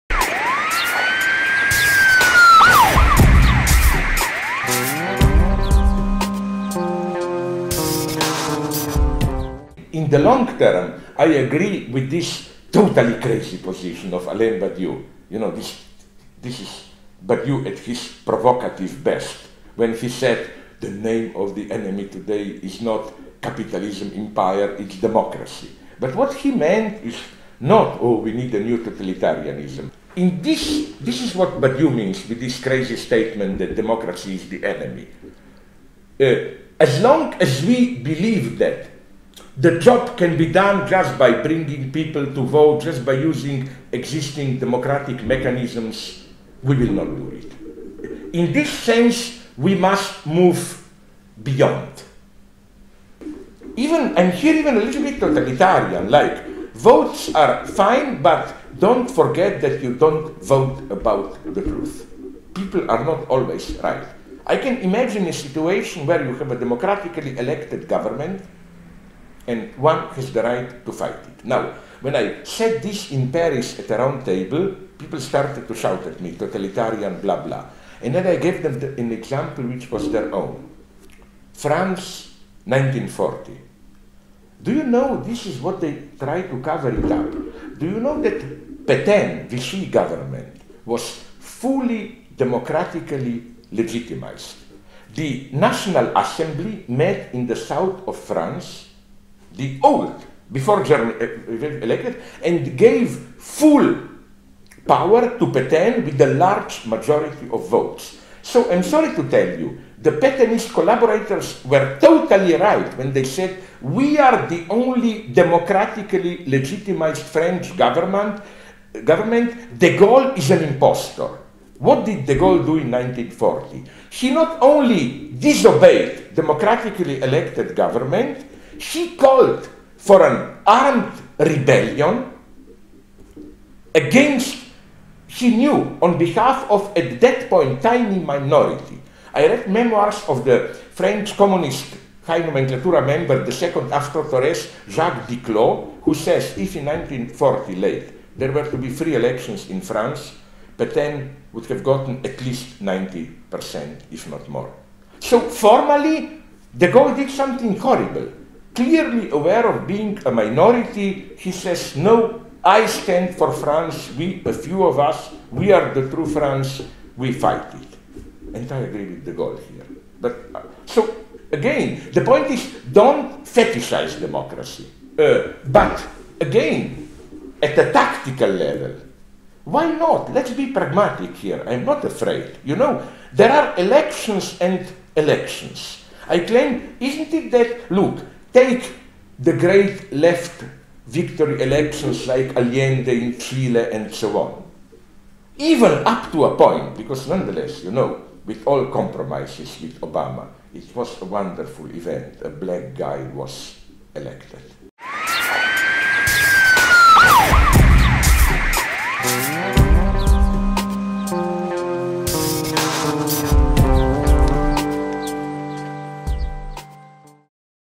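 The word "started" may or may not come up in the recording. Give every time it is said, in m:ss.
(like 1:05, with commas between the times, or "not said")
1:15.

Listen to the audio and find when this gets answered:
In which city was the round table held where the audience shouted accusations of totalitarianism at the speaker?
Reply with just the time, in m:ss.
1:13.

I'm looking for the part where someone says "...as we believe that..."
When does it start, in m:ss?
0:37.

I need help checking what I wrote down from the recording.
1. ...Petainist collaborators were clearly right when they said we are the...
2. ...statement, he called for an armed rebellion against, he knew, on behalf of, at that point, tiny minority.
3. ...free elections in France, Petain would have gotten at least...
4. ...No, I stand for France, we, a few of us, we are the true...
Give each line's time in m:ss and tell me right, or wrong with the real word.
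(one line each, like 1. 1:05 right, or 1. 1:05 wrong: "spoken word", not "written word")
1. 1:50 wrong: "totally", not "clearly"
2. 2:07 wrong: "government", not "statement"
3. 2:28 right
4. 2:41 right.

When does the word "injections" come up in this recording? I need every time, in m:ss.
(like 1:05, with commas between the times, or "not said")
not said.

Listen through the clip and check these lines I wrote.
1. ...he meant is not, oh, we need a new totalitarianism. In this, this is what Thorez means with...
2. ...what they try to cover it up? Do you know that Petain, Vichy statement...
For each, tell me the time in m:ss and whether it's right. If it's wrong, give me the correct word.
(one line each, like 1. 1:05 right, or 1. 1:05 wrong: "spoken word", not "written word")
1. 0:26 wrong: "Badiou", not "Thorez"
2. 1:25 wrong: "government", not "statement".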